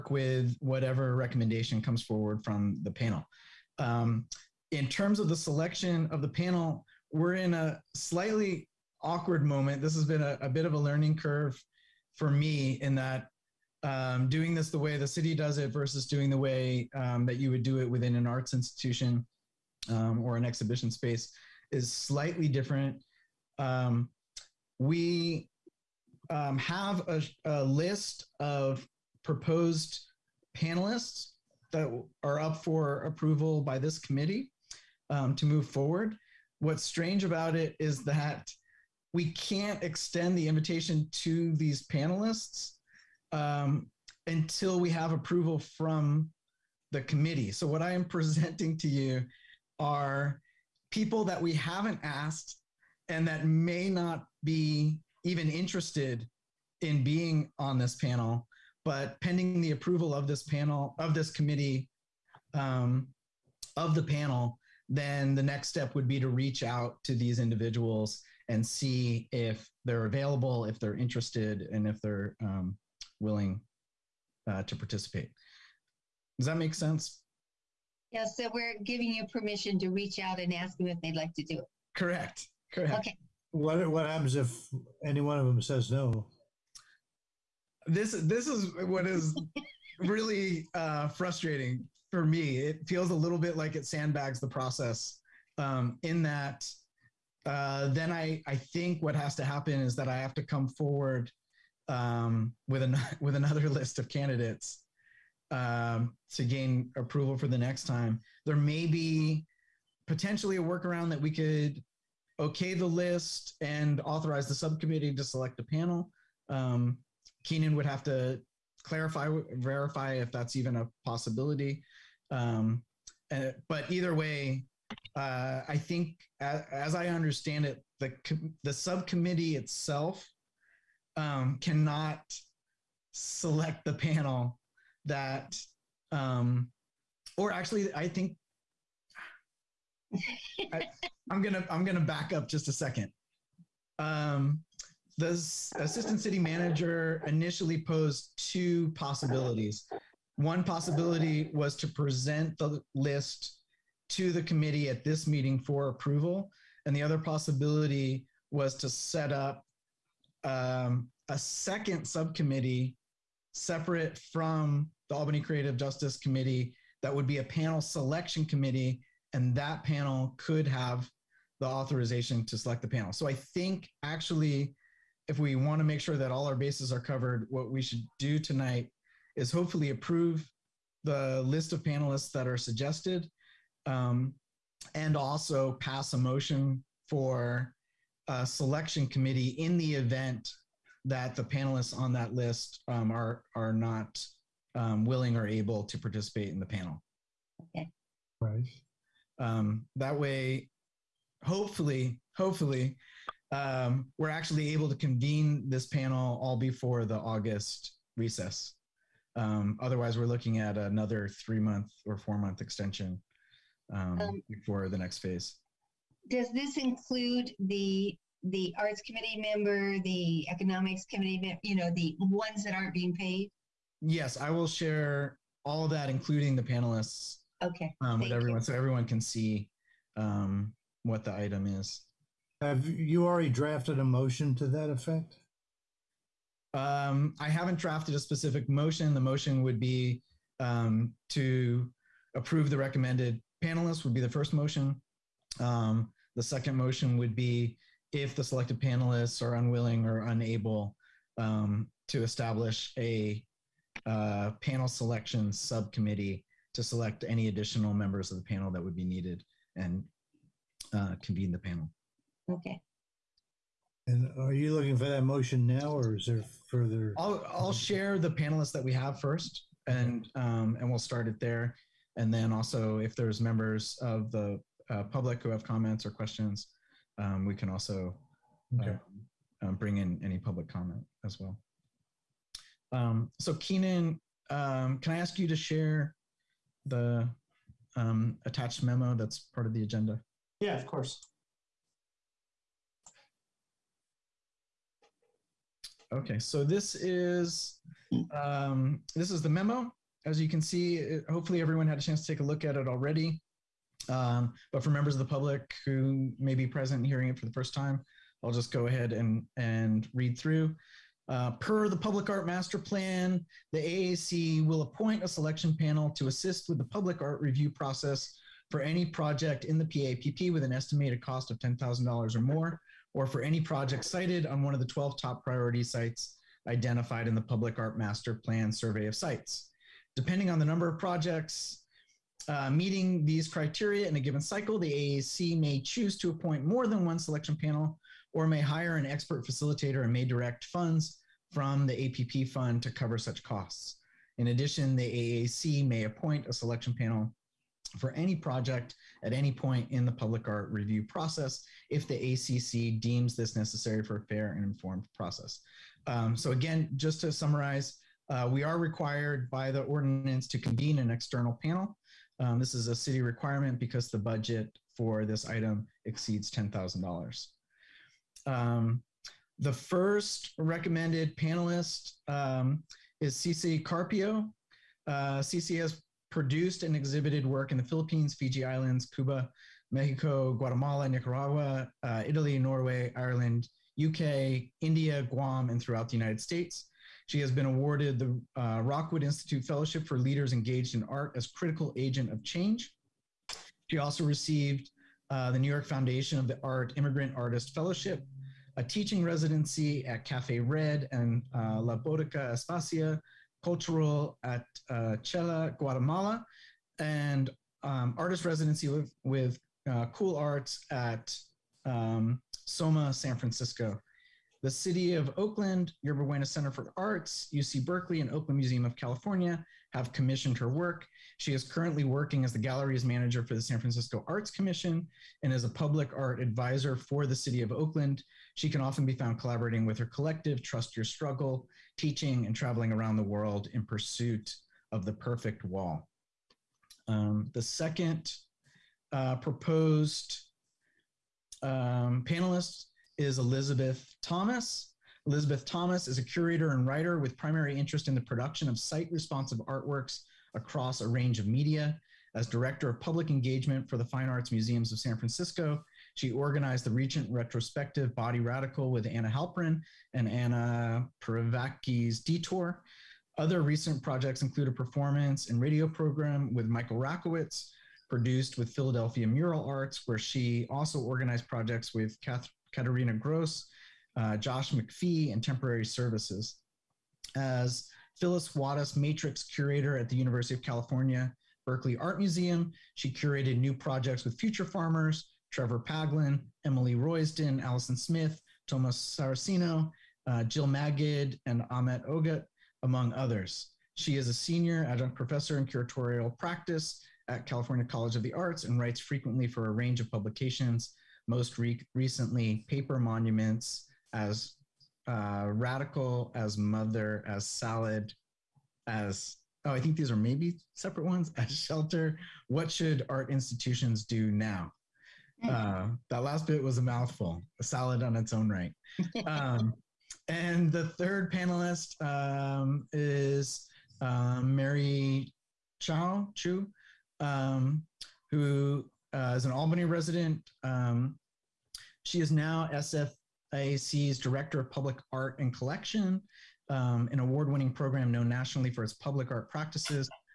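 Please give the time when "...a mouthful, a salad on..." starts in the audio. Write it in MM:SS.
08:36.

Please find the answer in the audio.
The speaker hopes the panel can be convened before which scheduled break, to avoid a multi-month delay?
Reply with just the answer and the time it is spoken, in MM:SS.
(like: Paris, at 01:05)
August recess, at 03:27.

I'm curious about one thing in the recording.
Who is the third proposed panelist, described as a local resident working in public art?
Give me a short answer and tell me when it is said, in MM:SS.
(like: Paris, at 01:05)
Mary Chao Chu, at 08:44.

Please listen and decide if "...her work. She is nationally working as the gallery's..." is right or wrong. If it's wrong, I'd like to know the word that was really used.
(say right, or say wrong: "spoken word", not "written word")
wrong: "currently", not "nationally".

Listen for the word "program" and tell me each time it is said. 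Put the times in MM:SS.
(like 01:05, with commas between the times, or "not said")
07:45, 08:57.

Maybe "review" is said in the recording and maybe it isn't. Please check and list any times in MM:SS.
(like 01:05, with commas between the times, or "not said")
05:17, 05:50.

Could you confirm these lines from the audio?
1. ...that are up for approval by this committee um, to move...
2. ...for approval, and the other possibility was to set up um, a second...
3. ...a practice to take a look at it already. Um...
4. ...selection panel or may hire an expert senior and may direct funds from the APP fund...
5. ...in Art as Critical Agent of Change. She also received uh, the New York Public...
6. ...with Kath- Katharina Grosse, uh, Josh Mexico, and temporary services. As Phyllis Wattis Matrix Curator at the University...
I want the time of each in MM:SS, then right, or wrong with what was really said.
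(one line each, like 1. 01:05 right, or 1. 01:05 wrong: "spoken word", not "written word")
1. 00:31 right
2. 02:35 right
3. 05:01 wrong: "chance", not "practice"
4. 05:37 wrong: "facilitator", not "senior"
5. 06:30 wrong: "Foundation", not "Public"
6. 07:51 wrong: "MacPhee", not "Mexico".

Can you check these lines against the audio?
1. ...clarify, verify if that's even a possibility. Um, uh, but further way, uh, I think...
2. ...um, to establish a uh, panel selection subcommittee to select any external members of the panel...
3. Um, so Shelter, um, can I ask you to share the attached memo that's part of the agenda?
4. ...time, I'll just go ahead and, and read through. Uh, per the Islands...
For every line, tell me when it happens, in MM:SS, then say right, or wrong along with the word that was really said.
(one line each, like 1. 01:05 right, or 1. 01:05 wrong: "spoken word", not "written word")
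1. 01:58 wrong: "either", not "further"
2. 04:11 wrong: "additional", not "external"
3. 04:42 wrong: "Keenan", not "Shelter"
4. 05:07 wrong: "Public", not "Islands".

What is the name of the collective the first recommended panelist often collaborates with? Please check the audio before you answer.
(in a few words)
Trust Your Struggle.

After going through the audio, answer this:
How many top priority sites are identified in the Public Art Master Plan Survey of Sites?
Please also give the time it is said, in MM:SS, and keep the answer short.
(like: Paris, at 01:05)
12, at 05:24.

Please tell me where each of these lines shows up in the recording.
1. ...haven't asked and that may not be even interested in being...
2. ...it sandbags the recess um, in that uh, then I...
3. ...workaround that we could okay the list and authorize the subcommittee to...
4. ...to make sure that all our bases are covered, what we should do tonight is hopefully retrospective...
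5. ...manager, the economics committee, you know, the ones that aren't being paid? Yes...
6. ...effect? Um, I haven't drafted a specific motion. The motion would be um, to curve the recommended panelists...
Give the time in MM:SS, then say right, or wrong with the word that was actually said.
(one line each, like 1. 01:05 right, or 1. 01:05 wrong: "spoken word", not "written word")
1. 00:51 right
2. 01:33 wrong: "process", not "recess"
3. 01:50 right
4. 02:55 wrong: "approve", not "retrospective"
5. 03:39 wrong: "member", not "manager"
6. 03:54 wrong: "approve", not "curve".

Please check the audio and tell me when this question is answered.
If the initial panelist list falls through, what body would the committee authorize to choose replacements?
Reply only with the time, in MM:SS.
02:47.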